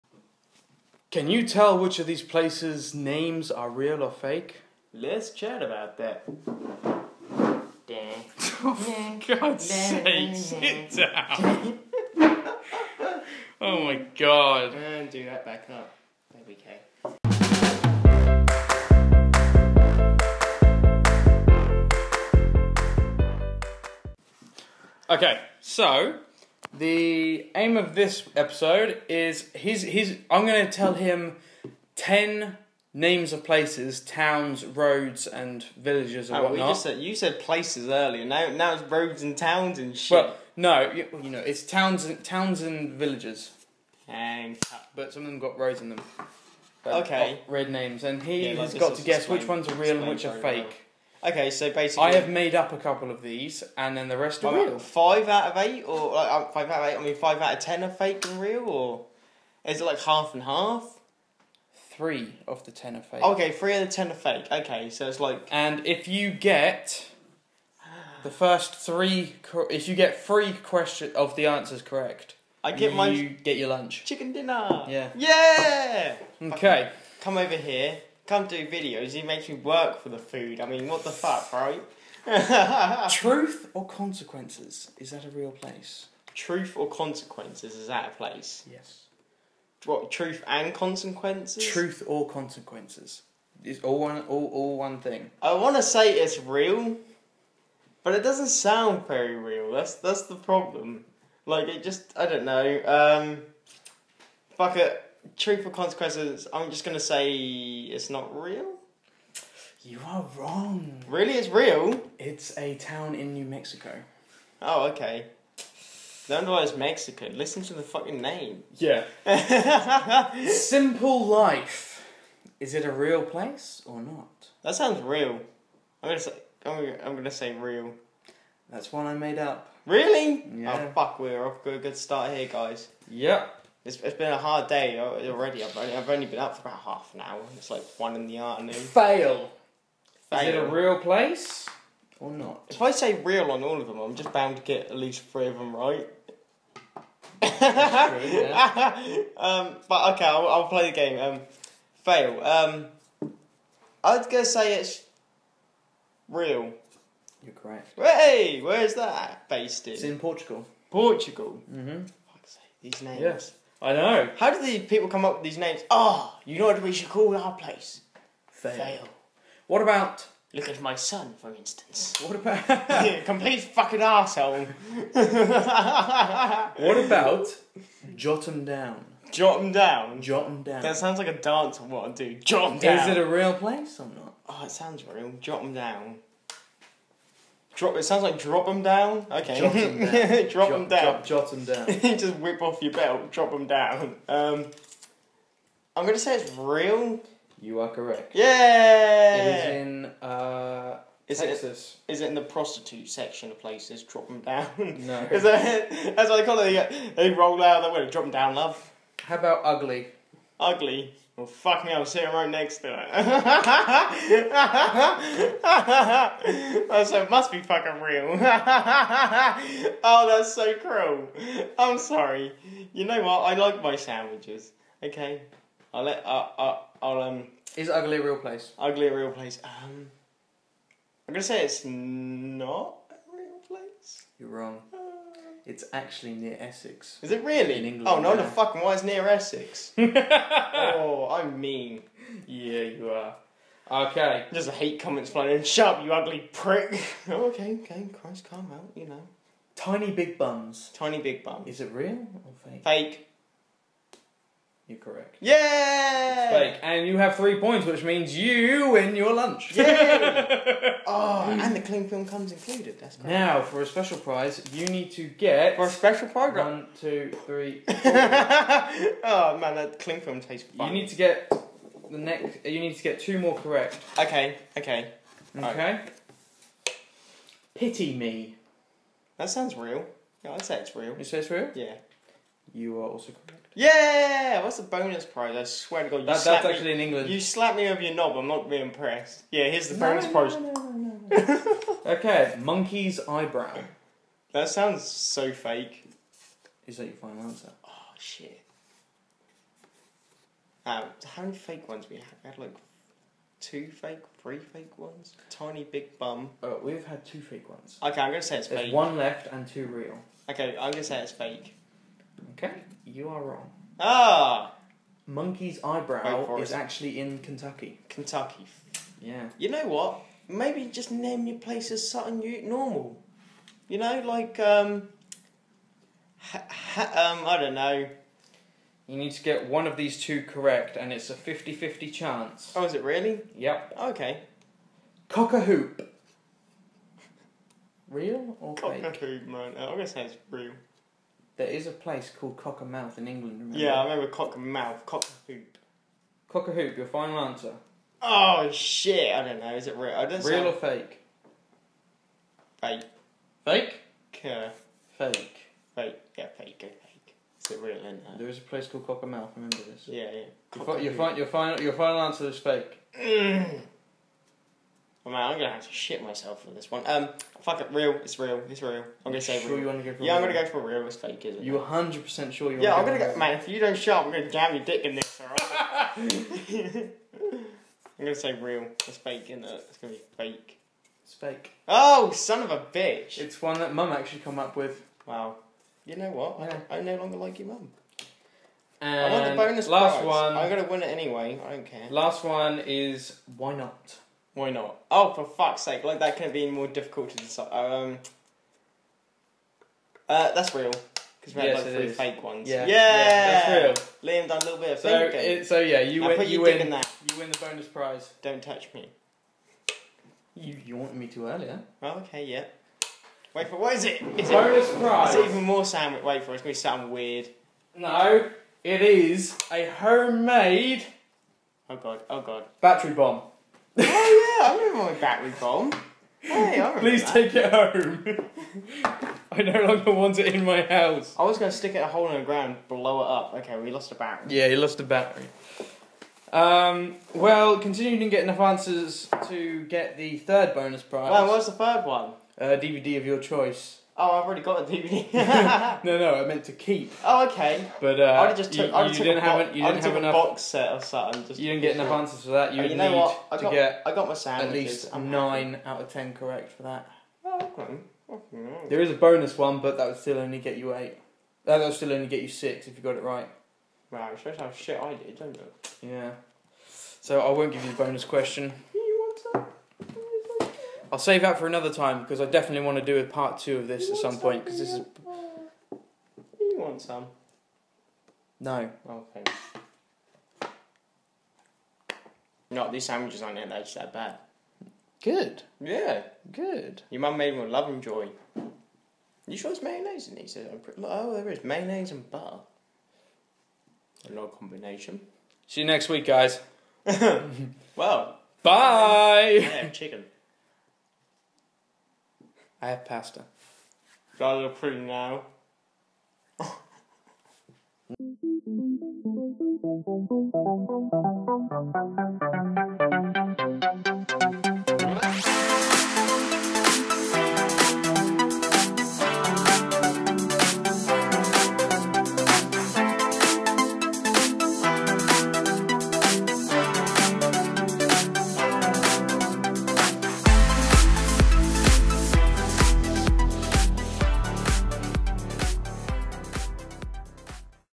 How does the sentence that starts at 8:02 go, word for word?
No, these sandwiches aren't that bad.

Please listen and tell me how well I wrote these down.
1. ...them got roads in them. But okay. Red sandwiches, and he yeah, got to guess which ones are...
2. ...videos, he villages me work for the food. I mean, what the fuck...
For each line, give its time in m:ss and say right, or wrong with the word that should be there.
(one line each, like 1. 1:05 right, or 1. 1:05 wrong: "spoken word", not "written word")
1. 0:45 wrong: "names", not "sandwiches"
2. 1:18 wrong: "makes", not "villages".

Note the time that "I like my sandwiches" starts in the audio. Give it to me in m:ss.
3:43.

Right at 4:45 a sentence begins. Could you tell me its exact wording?
I swear to God, you that, that's me, actually in England.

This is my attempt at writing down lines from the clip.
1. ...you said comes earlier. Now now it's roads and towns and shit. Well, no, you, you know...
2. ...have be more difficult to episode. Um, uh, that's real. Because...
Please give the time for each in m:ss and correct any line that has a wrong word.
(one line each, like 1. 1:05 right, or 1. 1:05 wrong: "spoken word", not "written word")
1. 0:36 wrong: "places", not "comes"
2. 6:36 wrong: "decide", not "episode".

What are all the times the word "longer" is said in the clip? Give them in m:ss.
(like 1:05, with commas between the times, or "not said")
6:27, 7:09.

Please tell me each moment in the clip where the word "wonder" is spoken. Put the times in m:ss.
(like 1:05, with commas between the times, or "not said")
1:56.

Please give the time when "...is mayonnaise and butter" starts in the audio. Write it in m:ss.
8:11.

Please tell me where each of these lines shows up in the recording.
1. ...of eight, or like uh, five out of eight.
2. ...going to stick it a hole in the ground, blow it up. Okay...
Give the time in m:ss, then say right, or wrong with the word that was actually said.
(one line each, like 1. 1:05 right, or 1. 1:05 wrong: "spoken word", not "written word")
1. 0:55 right
2. 7:11 right.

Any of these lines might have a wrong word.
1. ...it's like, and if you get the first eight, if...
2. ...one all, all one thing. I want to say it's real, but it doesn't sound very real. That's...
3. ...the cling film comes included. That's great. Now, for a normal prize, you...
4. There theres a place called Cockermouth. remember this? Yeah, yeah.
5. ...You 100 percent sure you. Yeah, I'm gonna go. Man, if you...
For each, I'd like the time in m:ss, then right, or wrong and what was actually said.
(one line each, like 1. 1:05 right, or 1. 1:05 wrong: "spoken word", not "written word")
1. 1:05 wrong: "three", not "eight"
2. 1:33 right
3. 4:21 wrong: "special", not "normal"
4. 5:58 right
5. 6:11 right.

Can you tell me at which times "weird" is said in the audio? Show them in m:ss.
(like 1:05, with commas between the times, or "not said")
6:57.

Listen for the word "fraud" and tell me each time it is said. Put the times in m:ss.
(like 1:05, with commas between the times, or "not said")
not said.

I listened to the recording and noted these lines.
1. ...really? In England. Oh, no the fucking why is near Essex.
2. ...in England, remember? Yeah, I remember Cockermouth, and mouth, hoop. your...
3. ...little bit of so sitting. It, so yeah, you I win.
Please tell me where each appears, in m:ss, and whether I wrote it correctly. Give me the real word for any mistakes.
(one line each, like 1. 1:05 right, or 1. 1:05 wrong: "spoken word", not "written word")
1. 3:57 right
2. 5:43 right
3. 6:44 wrong: "thinking", not "sitting".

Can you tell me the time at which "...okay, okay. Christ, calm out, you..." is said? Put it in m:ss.
4:07.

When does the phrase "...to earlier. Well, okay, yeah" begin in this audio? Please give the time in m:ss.
6:51.